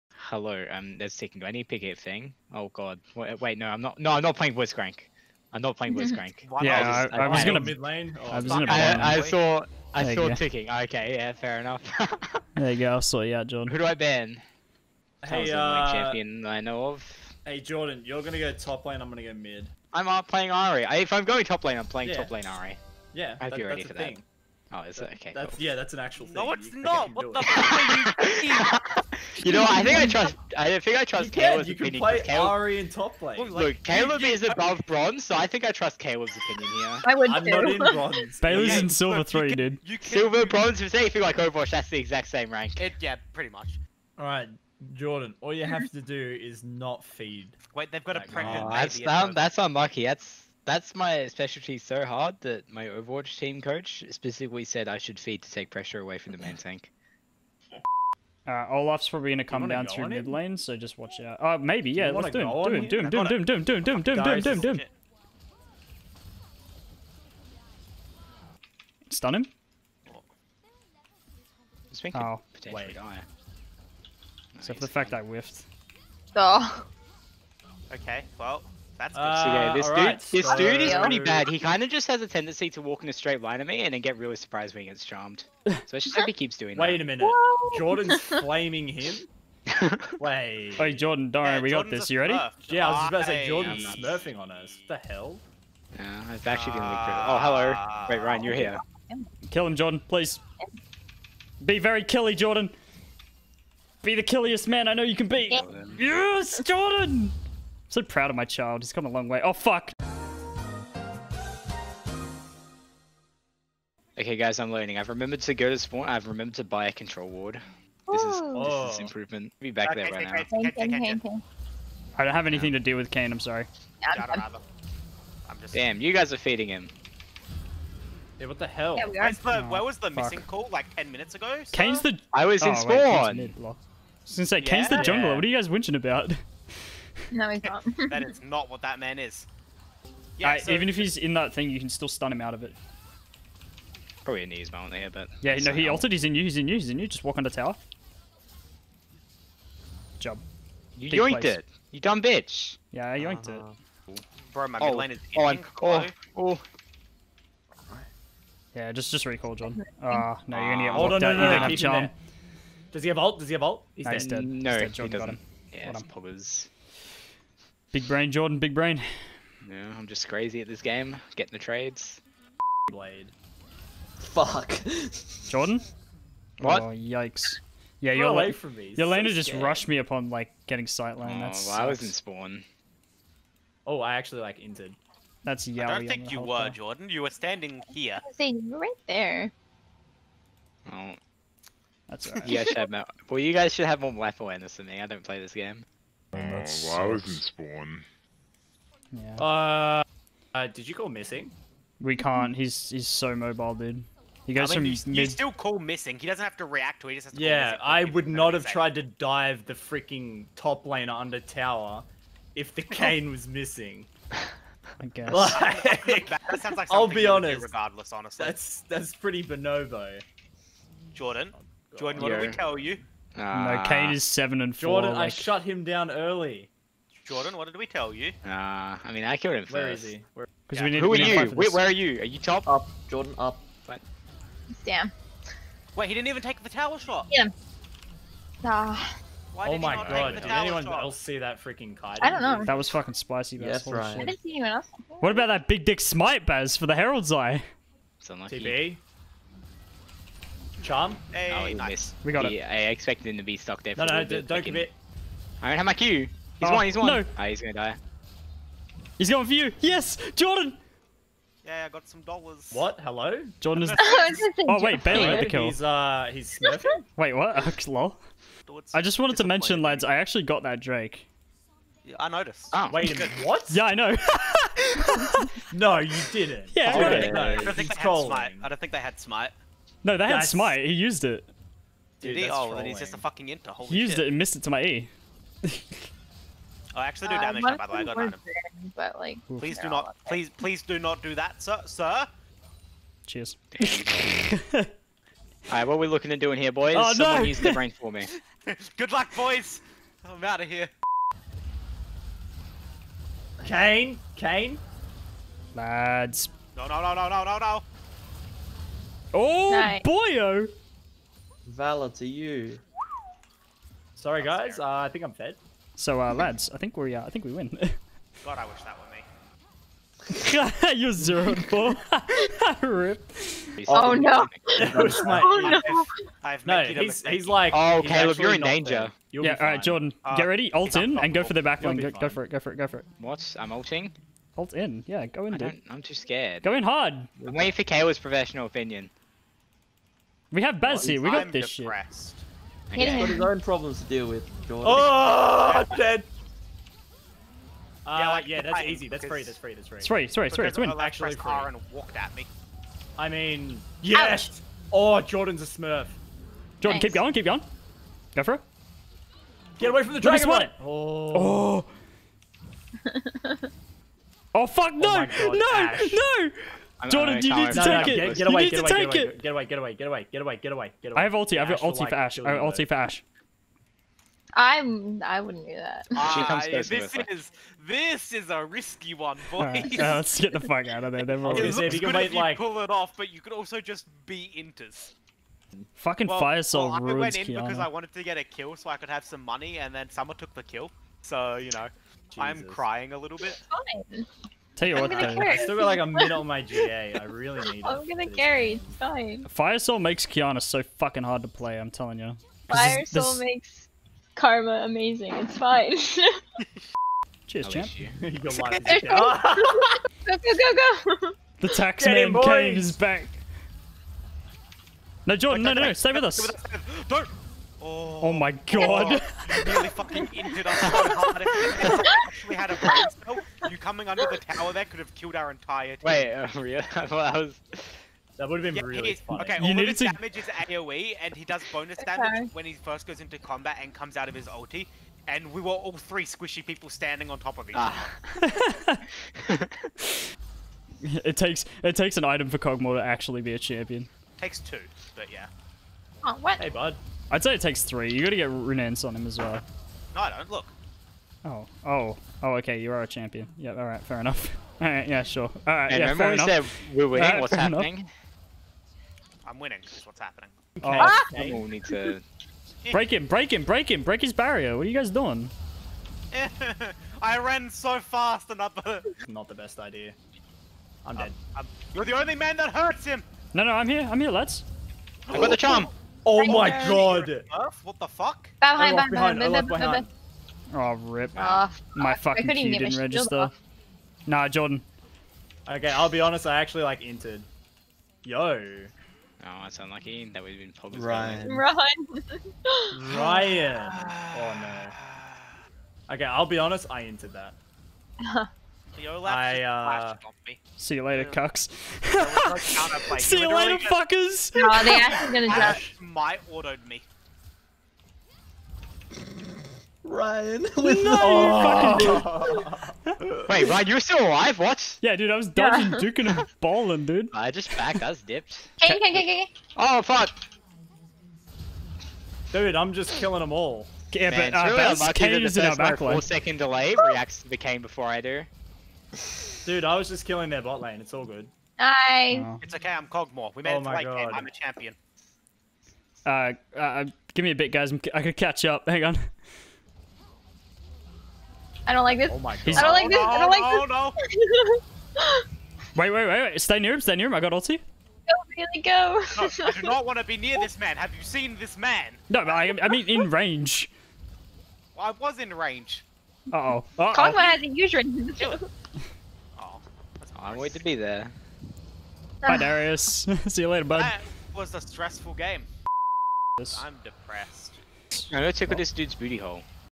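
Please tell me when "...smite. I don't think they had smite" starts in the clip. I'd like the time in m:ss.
4:38.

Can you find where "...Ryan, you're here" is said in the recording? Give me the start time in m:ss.
1:38.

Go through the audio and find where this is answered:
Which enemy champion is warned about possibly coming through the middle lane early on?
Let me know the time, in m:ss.
0:58.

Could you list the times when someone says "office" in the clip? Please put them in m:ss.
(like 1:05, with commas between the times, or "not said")
not said.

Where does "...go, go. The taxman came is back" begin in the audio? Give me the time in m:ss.
6:50.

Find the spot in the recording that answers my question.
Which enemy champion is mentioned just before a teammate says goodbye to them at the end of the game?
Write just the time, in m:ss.
9:22.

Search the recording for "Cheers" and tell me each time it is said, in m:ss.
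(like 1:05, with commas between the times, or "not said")
4:53, 6:47.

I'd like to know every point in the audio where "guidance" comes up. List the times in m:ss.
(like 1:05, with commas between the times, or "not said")
not said.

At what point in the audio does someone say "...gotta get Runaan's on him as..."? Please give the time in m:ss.
7:28.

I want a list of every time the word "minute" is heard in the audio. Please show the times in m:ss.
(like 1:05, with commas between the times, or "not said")
1:27, 2:11, 4:33.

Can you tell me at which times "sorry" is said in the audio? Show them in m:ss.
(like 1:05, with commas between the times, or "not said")
2:03, 5:14.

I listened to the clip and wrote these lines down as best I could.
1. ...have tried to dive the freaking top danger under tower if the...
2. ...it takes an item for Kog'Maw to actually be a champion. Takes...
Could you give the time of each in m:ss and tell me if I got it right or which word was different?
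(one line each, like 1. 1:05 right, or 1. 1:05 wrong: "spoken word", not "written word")
1. 3:28 wrong: "laner", not "danger"
2. 7:21 right.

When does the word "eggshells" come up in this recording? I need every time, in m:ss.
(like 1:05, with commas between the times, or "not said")
not said.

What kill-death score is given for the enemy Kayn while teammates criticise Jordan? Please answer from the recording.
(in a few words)
7 and 4.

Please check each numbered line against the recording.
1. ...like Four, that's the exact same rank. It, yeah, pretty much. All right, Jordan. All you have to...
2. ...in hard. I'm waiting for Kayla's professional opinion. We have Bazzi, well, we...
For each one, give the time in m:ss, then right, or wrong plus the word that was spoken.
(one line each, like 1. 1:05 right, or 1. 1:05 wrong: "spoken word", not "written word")
1. 0:41 wrong: "Overwatch", not "Four"
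2. 5:36 right.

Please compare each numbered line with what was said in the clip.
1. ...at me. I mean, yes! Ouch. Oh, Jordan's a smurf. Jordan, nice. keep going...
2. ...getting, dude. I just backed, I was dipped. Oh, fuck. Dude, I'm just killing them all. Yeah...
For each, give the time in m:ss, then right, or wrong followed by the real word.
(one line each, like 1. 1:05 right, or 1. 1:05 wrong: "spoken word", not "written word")
1. 5:52 right
2. 8:36 wrong: "balling", not "getting".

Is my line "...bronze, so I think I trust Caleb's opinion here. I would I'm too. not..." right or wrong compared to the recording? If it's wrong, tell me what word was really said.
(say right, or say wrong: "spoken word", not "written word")
right.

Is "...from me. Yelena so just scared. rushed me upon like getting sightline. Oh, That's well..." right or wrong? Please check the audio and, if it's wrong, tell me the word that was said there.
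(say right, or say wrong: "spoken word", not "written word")
right.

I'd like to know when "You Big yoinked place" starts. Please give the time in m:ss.
2:30.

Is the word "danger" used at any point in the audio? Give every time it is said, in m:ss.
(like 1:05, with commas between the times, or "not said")
5:28.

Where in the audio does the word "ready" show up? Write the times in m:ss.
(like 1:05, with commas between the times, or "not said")
0:23, 1:32, 5:30.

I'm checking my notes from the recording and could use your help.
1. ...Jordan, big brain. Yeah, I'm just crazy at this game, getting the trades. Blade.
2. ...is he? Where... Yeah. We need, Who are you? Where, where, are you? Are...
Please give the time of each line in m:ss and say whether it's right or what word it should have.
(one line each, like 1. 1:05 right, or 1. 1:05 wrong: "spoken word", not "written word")
1. 2:48 right
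2. 3:49 right.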